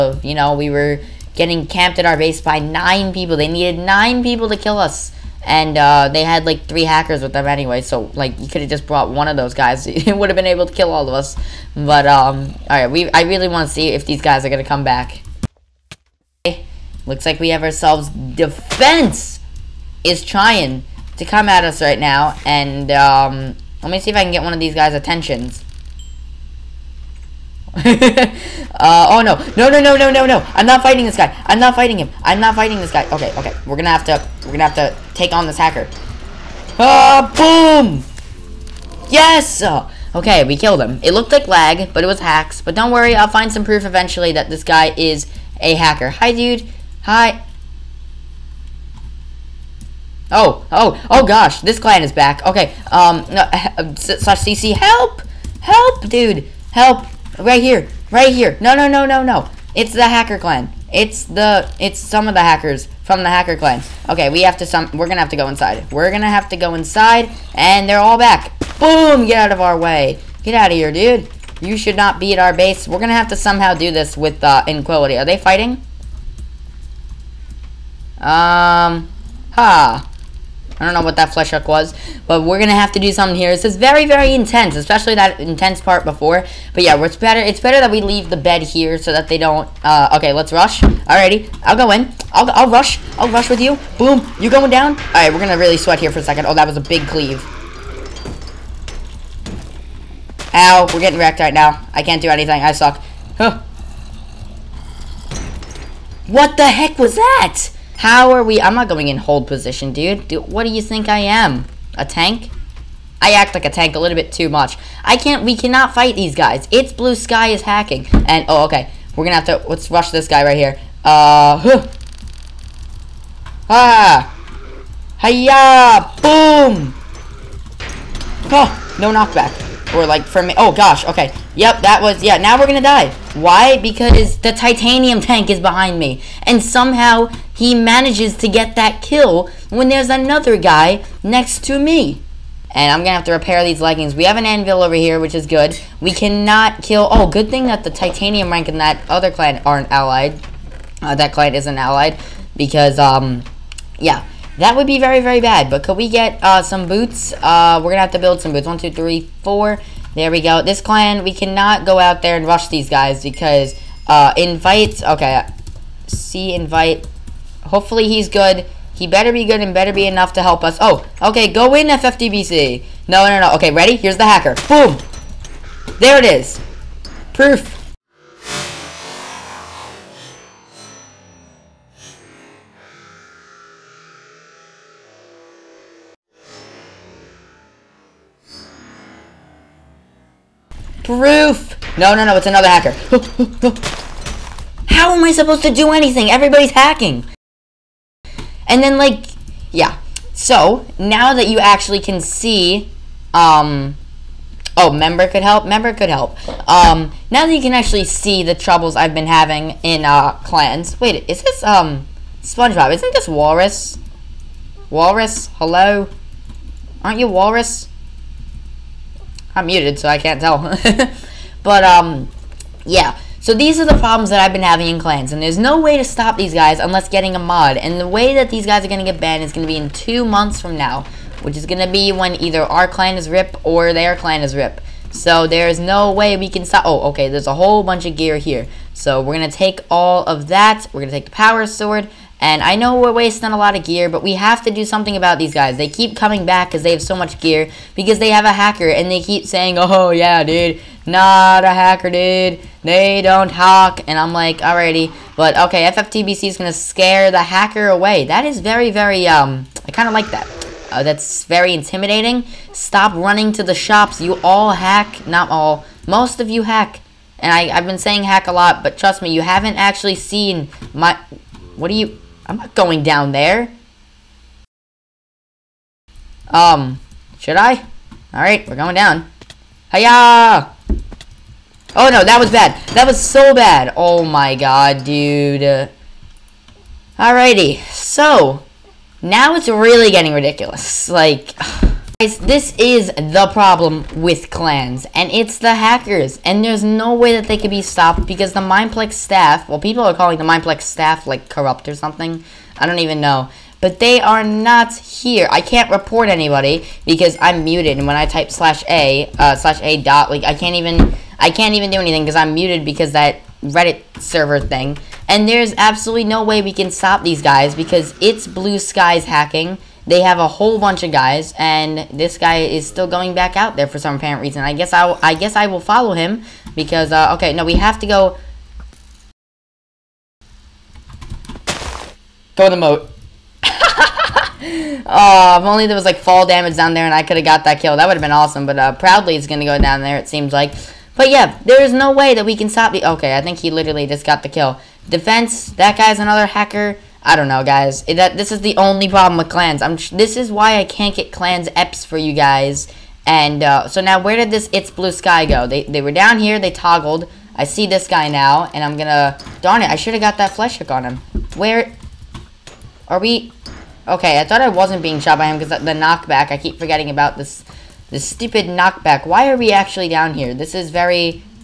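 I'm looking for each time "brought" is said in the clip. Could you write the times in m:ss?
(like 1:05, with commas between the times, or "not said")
0:08.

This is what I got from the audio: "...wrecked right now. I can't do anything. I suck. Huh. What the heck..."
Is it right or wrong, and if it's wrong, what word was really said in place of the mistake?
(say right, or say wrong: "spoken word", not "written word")
right.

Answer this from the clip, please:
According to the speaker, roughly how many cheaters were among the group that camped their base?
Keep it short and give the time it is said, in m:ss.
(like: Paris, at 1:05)
3, at 0:06.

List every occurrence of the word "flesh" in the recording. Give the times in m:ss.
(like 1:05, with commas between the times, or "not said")
1:21, 6:00.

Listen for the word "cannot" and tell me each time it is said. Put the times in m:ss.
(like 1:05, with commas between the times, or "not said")
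1:55, 2:26, 2:41.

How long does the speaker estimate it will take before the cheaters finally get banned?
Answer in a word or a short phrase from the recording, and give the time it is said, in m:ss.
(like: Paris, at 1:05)
2 months, at 3:49.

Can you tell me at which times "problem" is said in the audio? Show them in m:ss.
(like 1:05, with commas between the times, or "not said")
3:43, 4:53, 5:49.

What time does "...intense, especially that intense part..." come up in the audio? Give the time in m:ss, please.
1:24.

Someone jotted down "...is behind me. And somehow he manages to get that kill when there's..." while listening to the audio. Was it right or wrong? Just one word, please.
right.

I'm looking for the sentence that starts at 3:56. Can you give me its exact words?
Oh, okay, there's a whole bunch of gear here.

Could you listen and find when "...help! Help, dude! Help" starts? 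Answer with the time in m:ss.
0:54.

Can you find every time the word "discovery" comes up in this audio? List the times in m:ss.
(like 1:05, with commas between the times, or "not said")
not said.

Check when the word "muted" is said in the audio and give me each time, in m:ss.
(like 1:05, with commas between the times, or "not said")
3:39, 5:07, 5:12.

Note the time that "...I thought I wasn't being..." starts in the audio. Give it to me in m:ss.
6:04.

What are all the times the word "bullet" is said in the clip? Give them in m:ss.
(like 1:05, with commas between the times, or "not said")
not said.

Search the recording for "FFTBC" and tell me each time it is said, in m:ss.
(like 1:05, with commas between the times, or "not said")
2:51, 4:15.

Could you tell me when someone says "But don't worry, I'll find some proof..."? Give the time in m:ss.
0:42.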